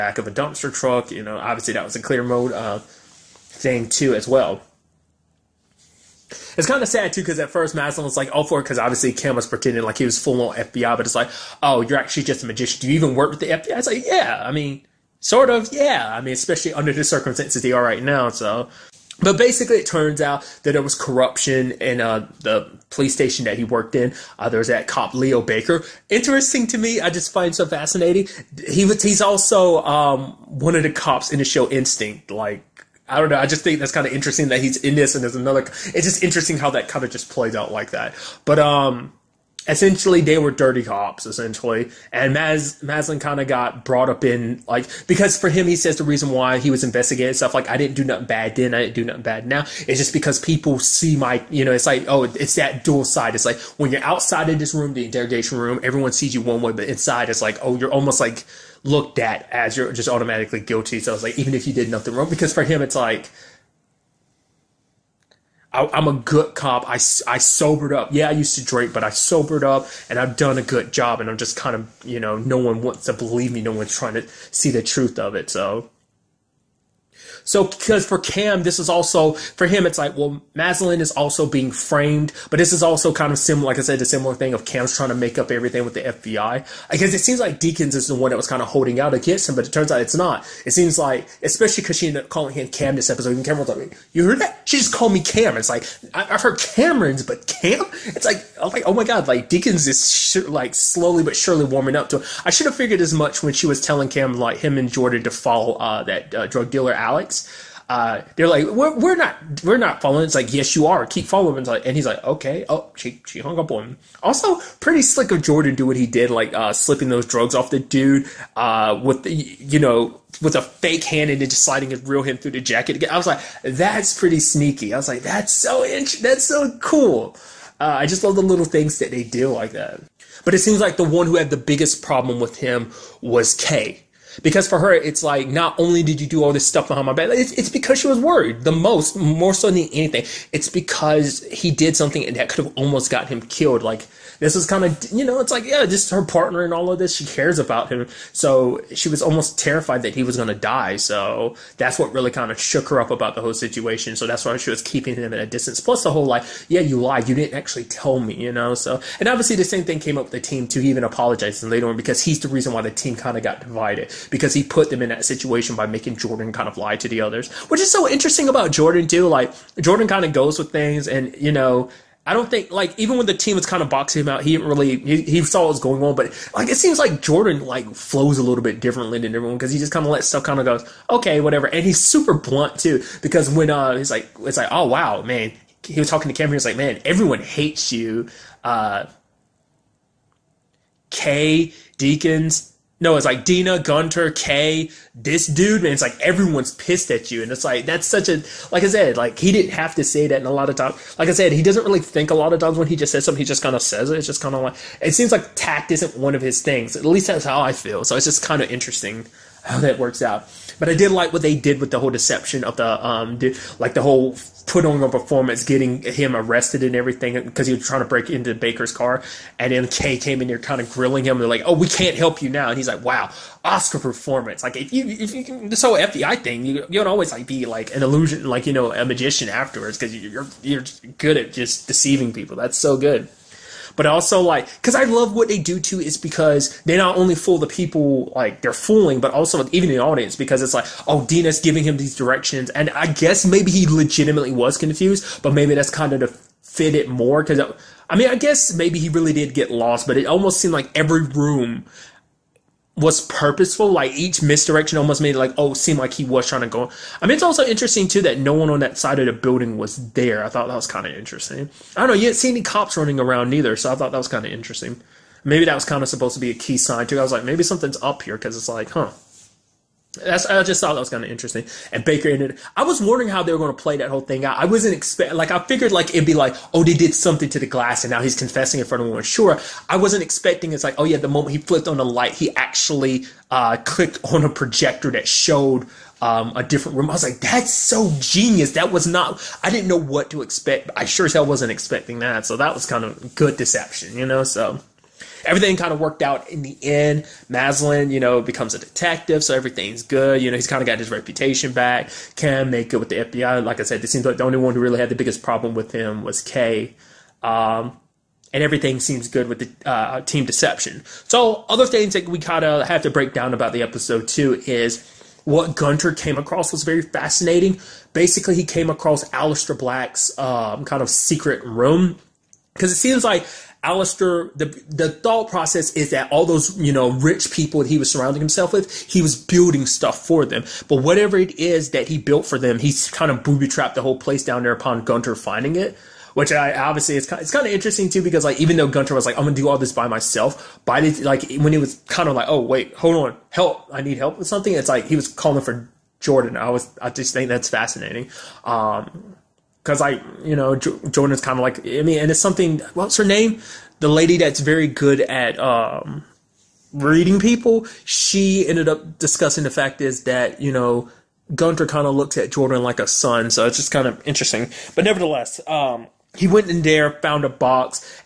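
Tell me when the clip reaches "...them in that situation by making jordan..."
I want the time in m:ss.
2:44.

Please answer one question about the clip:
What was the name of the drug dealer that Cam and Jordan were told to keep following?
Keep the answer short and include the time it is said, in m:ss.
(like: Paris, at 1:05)
Alex, at 1:46.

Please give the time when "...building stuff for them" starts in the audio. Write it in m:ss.
5:29.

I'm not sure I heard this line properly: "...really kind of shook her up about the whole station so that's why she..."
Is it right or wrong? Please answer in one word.
wrong.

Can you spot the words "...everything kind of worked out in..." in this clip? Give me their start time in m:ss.
4:55.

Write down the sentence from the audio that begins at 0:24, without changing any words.
Uh, there was that cop Leo Baker.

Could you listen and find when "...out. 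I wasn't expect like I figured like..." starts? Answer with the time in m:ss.
4:34.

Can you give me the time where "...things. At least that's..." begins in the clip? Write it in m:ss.
3:26.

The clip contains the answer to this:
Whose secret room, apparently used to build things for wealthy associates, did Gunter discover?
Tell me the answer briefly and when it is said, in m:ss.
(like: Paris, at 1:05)
Alistair Black, at 5:19.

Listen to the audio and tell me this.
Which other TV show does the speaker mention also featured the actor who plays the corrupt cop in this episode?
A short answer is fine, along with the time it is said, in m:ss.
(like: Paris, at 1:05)
Instinct, at 0:31.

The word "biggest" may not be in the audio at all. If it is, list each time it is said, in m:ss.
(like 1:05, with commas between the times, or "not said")
2:11, 5:05.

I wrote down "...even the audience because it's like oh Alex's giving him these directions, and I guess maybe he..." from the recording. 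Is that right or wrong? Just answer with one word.
wrong.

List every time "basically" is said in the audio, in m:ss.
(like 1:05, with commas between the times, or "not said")
0:19, 5:18.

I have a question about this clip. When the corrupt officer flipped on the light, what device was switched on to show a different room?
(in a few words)
A projector.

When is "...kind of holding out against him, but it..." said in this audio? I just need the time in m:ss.
1:28.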